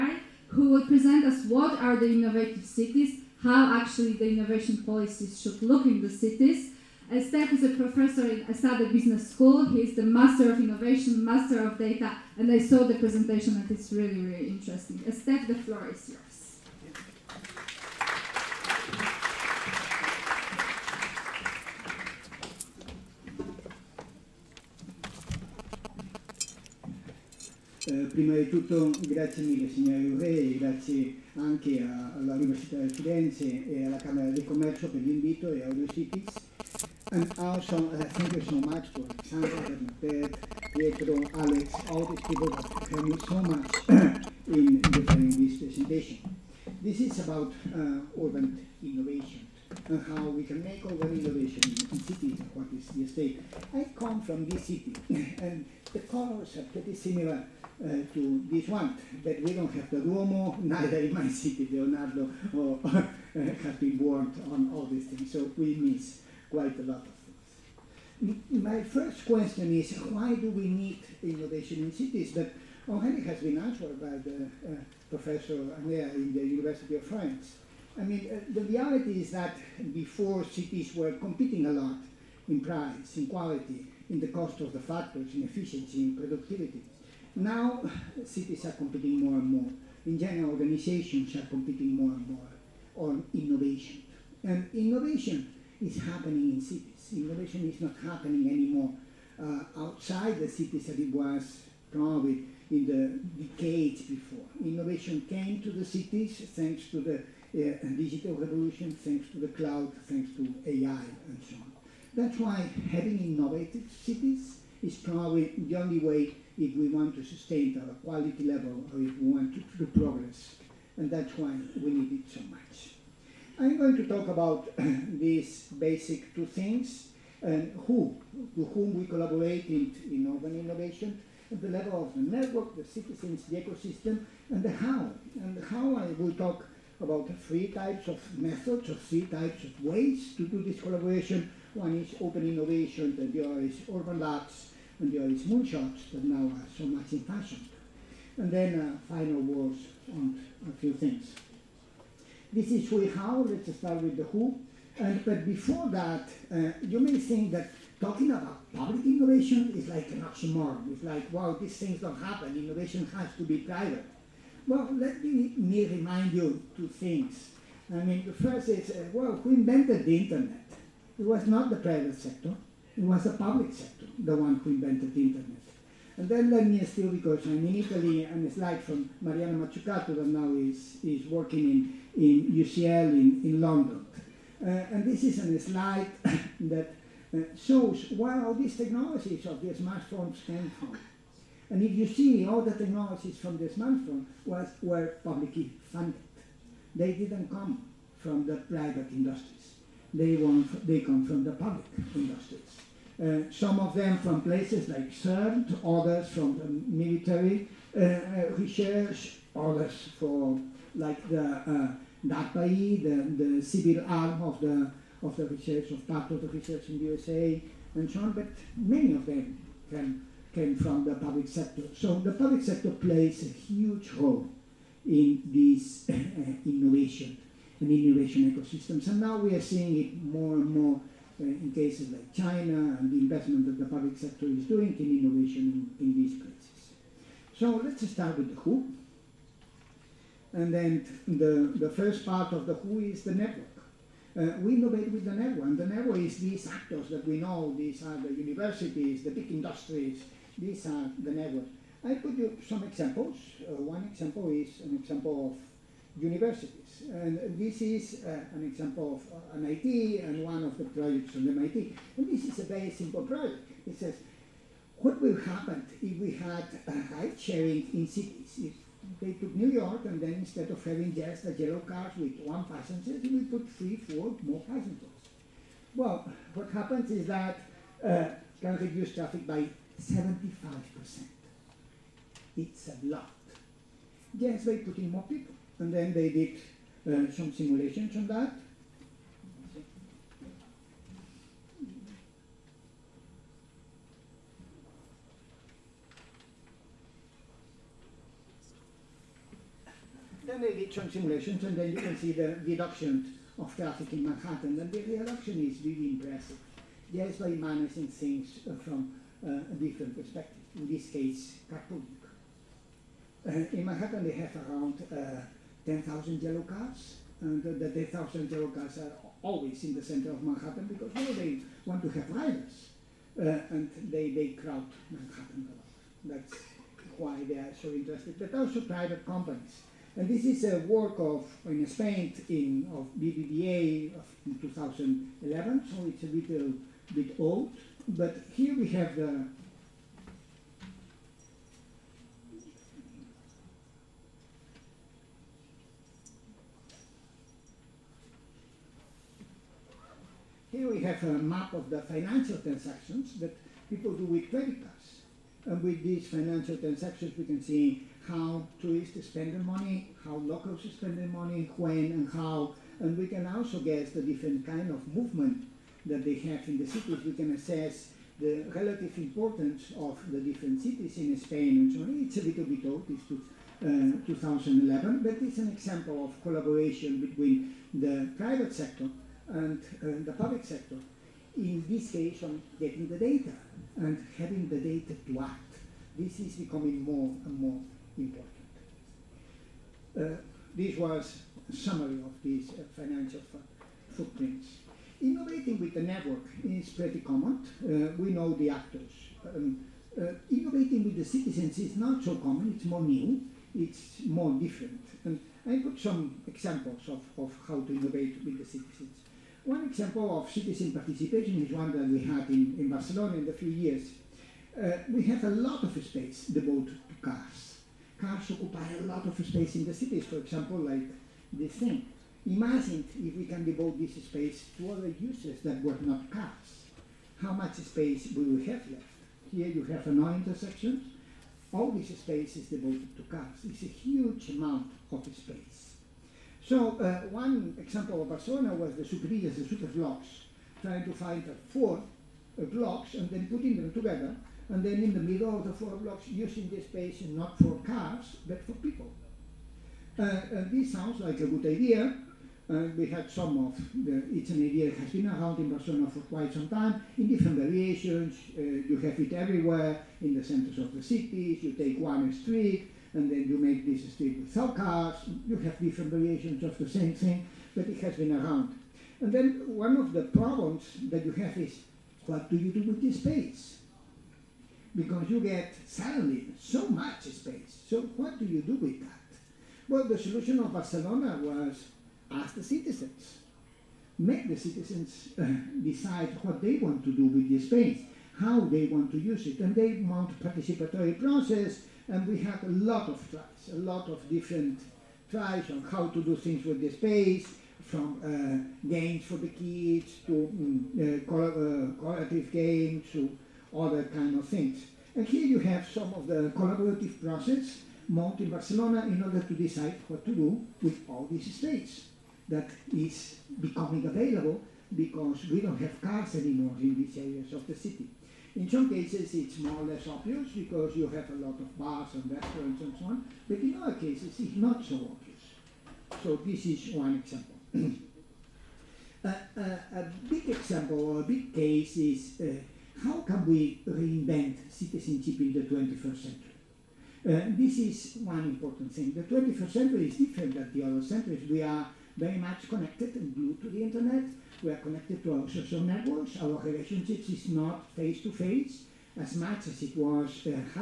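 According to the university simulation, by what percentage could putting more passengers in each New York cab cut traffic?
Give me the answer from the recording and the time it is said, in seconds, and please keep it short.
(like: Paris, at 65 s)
75%, at 280 s.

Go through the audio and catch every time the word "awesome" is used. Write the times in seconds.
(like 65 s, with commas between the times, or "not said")
not said.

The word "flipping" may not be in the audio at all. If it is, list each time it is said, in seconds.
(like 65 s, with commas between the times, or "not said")
not said.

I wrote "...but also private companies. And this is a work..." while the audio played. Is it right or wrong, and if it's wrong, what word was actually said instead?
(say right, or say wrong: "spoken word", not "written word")
right.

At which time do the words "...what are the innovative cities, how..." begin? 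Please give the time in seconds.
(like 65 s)
1 s.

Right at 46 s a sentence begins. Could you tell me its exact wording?
This is about uh, urban innovation and how we can make urban innovation in cities, what is the state.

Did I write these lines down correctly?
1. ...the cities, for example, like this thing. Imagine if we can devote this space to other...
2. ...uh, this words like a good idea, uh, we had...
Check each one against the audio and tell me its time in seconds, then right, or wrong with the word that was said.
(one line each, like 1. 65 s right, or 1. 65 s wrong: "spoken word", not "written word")
1. 419 s right
2. 450 s wrong: "sounds", not "words".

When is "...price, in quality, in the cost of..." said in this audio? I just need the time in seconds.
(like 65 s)
82 s.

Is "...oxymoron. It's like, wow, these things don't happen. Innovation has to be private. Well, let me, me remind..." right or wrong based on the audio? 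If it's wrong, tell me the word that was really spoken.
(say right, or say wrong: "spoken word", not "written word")
right.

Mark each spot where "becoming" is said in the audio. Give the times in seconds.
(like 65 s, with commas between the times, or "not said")
386 s, 513 s.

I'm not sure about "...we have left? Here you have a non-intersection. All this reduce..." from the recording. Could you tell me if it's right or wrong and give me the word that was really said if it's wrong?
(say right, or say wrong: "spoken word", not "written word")
wrong: "space", not "reduce".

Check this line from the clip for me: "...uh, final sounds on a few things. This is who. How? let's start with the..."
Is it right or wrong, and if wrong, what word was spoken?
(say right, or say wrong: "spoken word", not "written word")
wrong: "words", not "sounds".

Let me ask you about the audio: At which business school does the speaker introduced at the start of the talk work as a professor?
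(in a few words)
ESADE Business School.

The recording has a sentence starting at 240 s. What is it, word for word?
And then the, the first part of the who is the network.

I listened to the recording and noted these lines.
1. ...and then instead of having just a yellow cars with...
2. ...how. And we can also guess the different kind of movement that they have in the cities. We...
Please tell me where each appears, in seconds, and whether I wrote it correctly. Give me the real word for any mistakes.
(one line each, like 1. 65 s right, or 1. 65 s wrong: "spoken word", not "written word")
1. 270 s right
2. 362 s right.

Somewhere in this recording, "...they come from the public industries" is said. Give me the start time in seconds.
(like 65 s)
200 s.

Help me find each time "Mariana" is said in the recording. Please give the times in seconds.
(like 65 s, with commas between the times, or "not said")
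179 s.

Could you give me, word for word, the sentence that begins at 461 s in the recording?
You take one street, and then you make this street with cars.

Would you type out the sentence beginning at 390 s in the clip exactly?
Uh, this was a summary of these uh, financial footprints.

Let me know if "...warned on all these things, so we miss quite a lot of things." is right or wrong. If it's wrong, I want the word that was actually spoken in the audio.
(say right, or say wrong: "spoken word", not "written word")
right.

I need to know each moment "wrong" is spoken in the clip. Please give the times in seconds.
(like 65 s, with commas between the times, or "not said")
not said.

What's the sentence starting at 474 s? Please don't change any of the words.
Because you get suddenly so much space.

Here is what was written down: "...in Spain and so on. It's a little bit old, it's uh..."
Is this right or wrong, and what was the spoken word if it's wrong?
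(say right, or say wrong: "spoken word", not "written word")
right.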